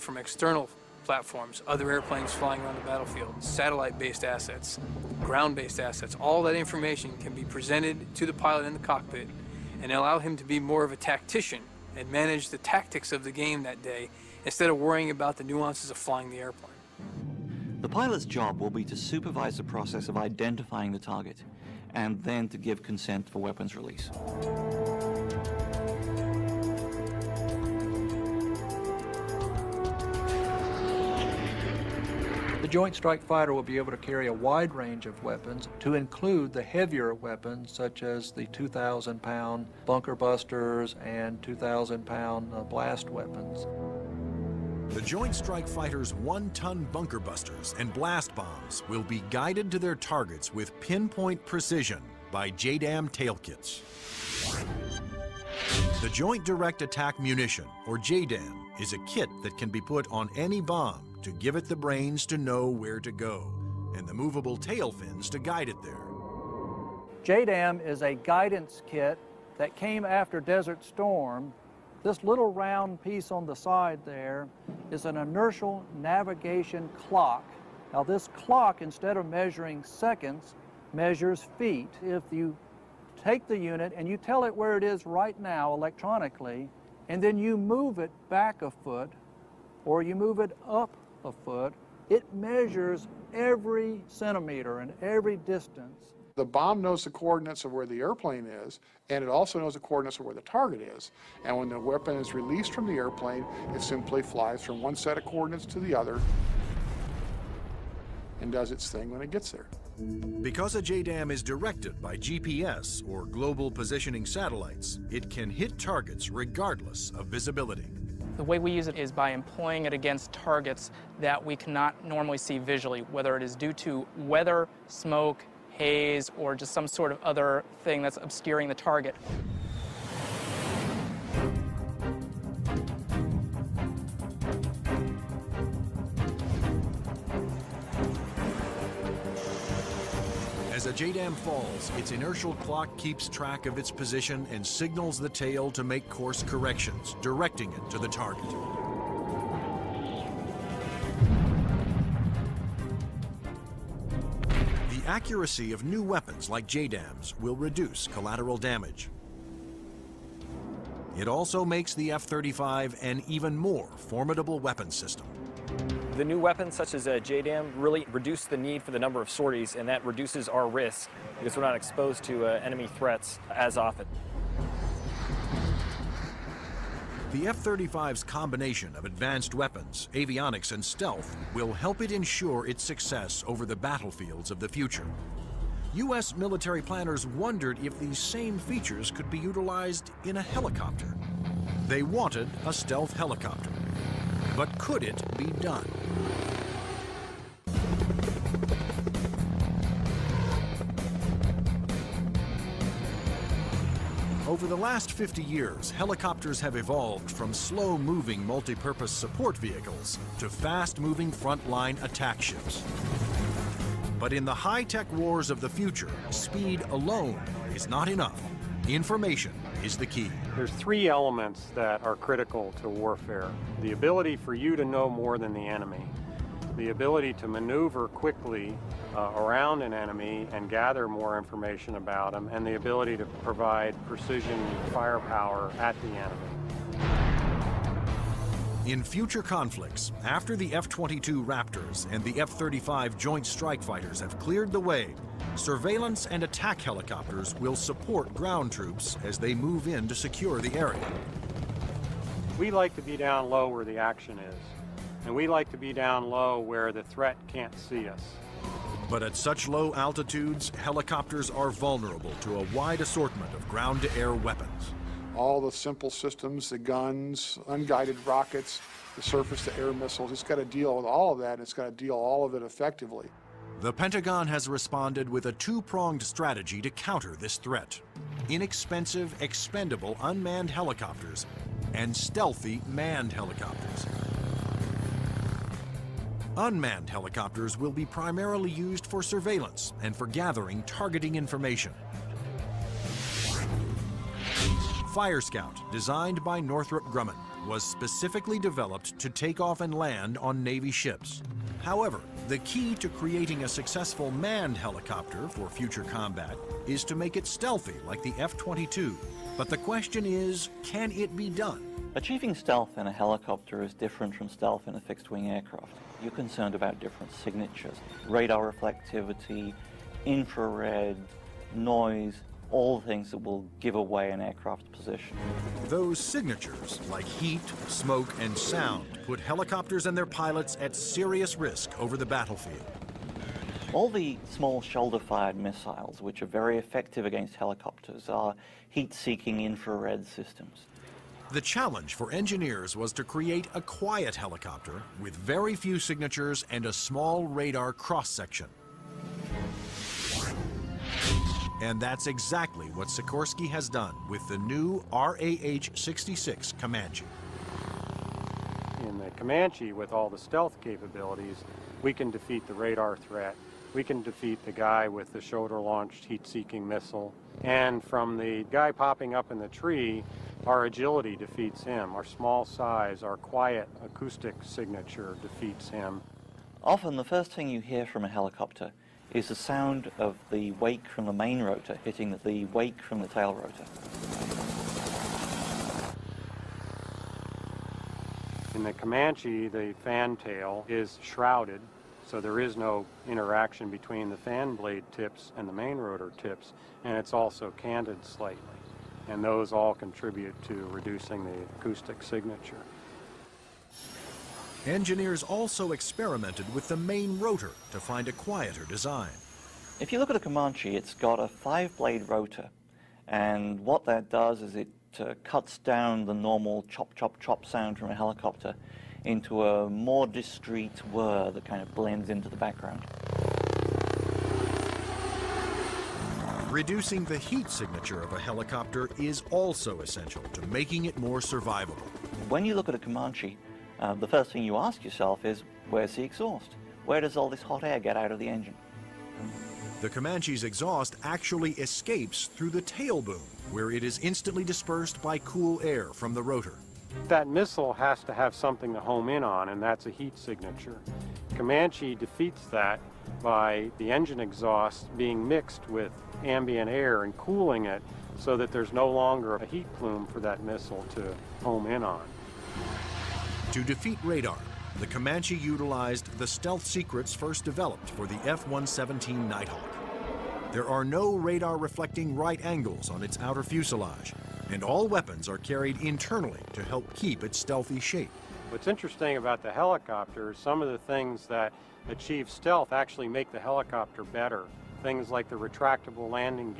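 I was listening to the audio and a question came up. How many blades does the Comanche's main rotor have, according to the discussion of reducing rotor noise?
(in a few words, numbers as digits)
5.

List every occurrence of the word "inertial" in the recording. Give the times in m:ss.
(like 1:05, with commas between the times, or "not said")
1:15, 2:22.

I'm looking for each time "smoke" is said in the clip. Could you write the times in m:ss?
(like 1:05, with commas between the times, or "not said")
2:04, 5:27.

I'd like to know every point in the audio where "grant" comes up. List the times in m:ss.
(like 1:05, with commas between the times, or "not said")
not said.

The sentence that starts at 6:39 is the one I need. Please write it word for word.
And those all contribute to reducing the acoustic signature.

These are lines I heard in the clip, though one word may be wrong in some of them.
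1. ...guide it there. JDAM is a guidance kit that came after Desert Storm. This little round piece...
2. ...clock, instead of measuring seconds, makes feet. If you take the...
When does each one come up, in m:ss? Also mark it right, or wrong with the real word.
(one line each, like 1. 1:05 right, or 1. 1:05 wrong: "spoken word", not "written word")
1. 1:05 right
2. 1:18 wrong: "measures", not "makes".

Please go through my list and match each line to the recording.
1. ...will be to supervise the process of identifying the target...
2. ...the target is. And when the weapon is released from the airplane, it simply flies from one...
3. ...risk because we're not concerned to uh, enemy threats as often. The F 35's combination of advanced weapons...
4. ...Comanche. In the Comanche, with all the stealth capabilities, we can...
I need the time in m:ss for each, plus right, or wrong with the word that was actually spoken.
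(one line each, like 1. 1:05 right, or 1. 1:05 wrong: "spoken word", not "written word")
1. 0:18 right
2. 1:40 right
3. 2:50 wrong: "exposed", not "concerned"
4. 5:56 right.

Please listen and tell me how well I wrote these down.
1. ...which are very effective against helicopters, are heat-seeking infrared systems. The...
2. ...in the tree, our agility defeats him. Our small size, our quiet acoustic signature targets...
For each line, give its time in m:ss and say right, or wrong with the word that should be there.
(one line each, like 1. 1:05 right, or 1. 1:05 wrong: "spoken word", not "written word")
1. 5:36 right
2. 6:09 wrong: "defeats", not "targets".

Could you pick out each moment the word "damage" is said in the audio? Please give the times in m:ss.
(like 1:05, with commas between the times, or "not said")
2:38.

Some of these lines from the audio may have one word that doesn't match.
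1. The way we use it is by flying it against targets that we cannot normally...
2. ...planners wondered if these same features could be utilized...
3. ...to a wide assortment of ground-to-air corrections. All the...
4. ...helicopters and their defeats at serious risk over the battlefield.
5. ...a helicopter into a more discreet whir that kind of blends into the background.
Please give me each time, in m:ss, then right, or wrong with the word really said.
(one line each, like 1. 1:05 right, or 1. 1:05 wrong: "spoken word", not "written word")
1. 1:58 wrong: "employing", not "flying"
2. 3:06 right
3. 4:22 wrong: "weapons", not "corrections"
4. 5:29 wrong: "pilots", not "defeats"
5. 6:58 right.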